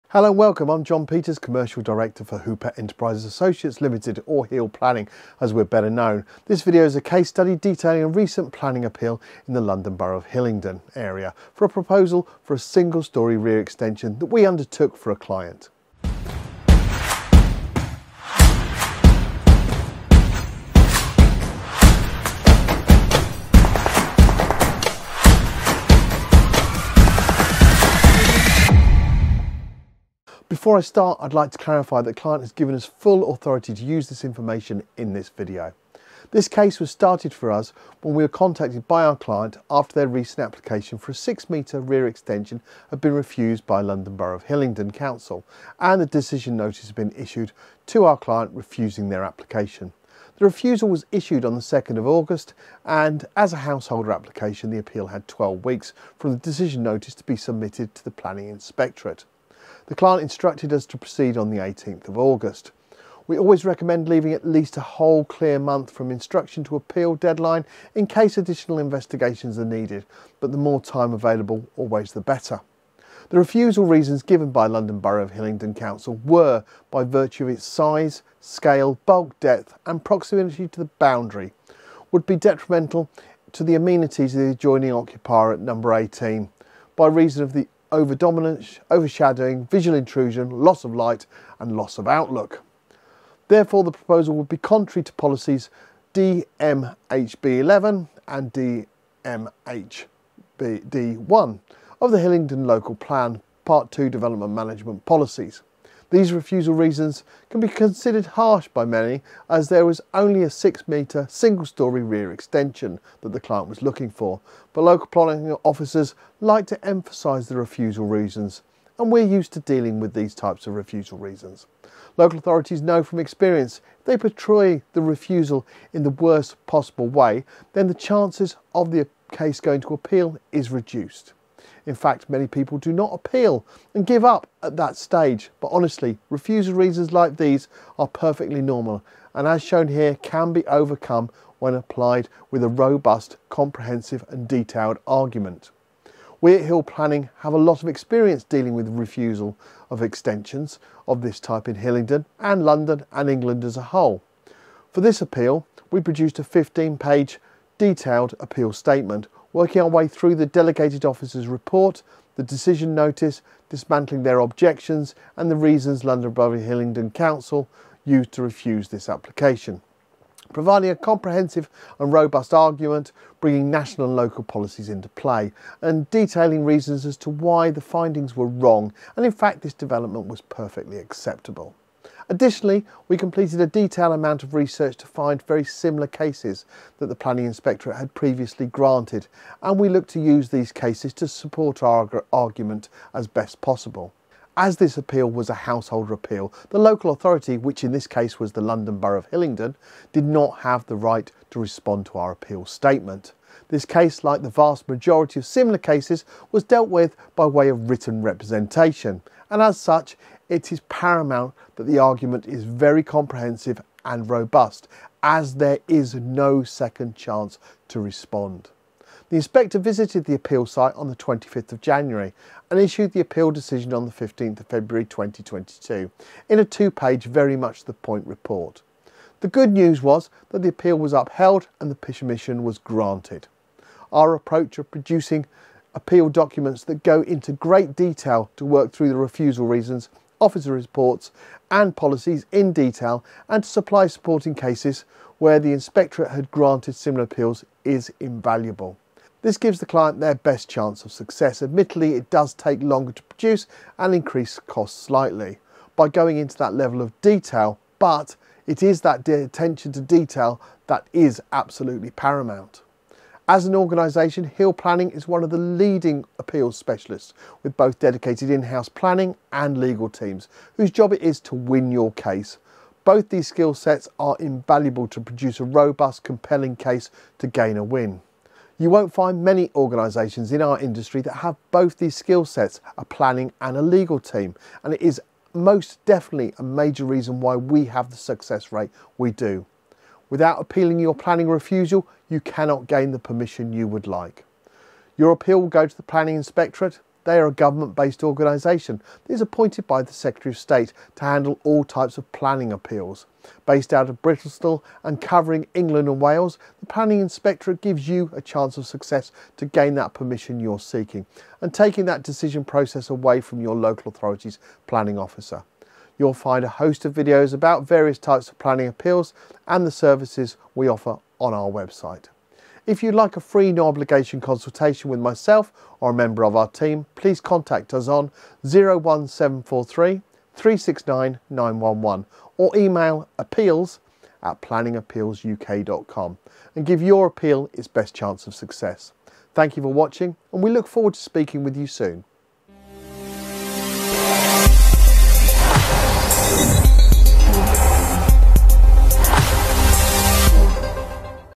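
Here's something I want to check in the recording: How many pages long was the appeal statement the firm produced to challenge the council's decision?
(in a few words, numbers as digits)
15.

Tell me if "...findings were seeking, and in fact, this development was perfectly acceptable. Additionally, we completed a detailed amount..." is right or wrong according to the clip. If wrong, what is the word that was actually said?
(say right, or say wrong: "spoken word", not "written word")
wrong: "wrong", not "seeking".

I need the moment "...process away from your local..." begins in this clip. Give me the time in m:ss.
5:12.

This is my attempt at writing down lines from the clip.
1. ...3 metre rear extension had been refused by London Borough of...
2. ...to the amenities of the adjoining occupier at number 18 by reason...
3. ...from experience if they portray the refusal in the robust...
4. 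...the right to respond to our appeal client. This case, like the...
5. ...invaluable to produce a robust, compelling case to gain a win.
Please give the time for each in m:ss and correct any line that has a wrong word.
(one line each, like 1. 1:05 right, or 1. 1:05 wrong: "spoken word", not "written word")
1. 0:41 wrong: "6", not "3"
2. 1:23 right
3. 2:03 wrong: "worst", not "robust"
4. 3:20 wrong: "statement", not "client"
5. 4:34 right.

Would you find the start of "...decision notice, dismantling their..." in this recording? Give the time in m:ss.
2:42.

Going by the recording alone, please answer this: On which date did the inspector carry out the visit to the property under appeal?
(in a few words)
25th of January.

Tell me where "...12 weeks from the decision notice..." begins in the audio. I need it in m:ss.
0:55.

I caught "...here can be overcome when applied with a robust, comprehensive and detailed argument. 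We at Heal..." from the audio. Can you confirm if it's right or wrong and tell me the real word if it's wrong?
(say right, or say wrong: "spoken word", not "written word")
right.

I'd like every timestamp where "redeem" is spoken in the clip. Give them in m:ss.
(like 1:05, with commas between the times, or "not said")
not said.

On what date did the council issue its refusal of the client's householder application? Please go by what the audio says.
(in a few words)
2nd of August.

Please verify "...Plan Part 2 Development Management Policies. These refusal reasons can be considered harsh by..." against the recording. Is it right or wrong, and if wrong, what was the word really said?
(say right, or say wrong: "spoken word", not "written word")
right.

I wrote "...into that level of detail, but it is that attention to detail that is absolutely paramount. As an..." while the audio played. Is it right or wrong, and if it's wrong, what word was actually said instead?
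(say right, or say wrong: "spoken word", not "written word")
right.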